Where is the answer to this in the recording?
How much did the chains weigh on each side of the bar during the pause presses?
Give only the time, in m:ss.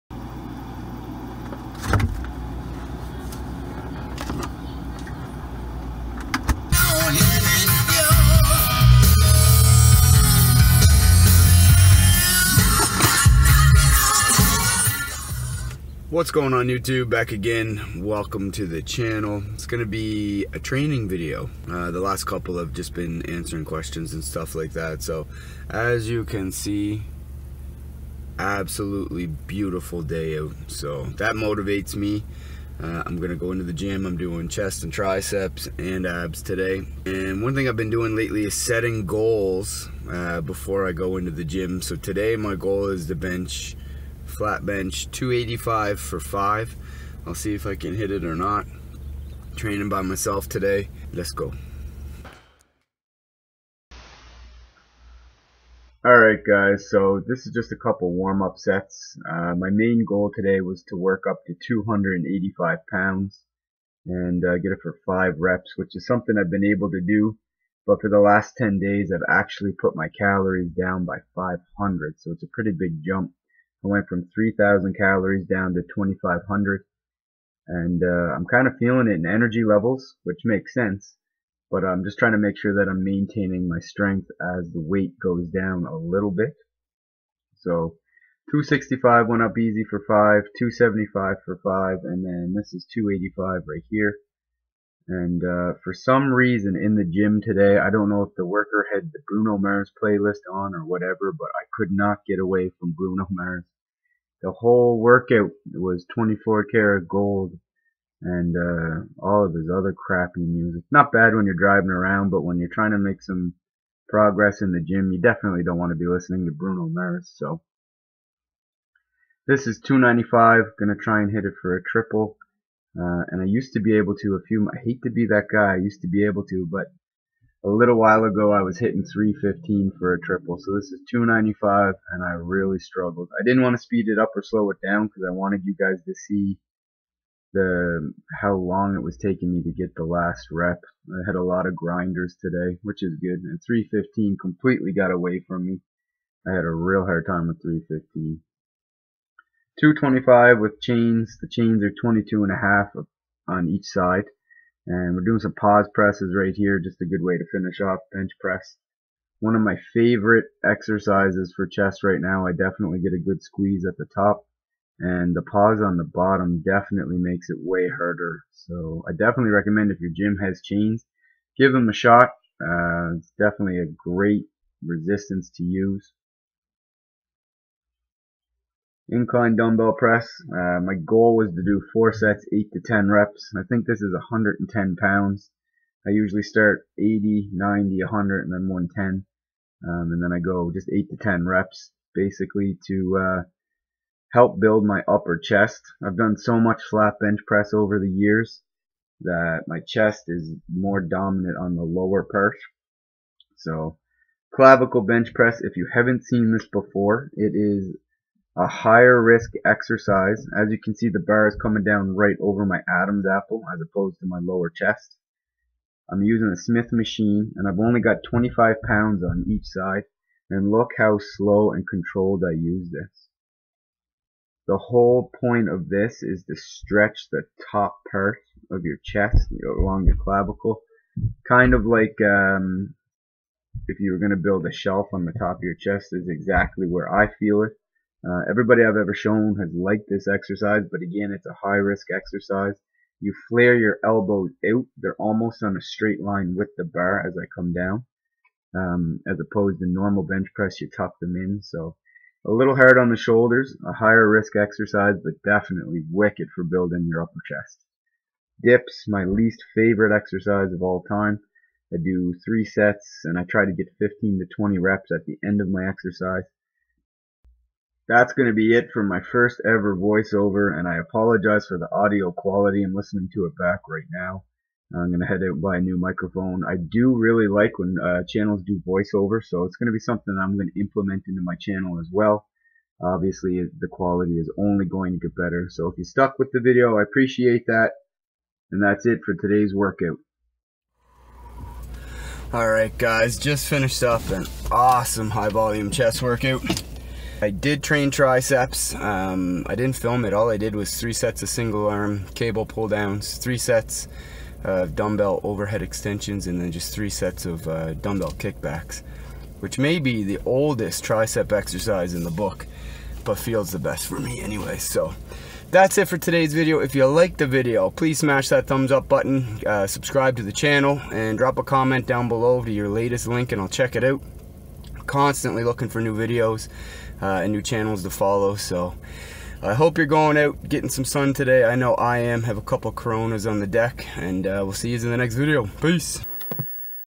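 2:32.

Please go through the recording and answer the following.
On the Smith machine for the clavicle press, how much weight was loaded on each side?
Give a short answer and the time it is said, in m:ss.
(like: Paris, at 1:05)
25 pounds, at 3:38.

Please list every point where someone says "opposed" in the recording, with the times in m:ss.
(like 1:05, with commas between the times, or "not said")
3:33, 4:09.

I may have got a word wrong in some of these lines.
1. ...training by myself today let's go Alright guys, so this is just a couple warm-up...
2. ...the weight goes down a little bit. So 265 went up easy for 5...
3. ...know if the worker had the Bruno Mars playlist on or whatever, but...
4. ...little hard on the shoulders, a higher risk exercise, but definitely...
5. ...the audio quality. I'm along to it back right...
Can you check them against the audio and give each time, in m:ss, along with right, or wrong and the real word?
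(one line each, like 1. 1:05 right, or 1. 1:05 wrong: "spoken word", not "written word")
1. 0:49 right
2. 1:24 right
3. 1:38 right
4. 4:12 right
5. 4:31 wrong: "listening", not "along".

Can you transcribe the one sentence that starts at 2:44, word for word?
And the pause on the bottom definitely makes it way harder.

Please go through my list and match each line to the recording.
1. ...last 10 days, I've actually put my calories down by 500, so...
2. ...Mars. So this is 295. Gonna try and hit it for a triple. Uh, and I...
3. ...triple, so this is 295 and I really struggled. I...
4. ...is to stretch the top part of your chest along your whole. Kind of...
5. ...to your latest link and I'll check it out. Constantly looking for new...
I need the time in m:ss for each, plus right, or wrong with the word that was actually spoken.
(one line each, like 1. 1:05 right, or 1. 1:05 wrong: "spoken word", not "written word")
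1. 1:08 right
2. 1:56 right
3. 2:10 right
4. 3:46 wrong: "clavicle", not "whole"
5. 5:22 right.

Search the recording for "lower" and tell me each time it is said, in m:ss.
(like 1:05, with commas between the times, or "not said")
3:21, 3:34.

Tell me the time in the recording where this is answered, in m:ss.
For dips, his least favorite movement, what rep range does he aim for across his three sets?
4:23.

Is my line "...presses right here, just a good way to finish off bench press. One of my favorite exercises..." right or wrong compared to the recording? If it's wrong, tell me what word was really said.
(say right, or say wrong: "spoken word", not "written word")
right.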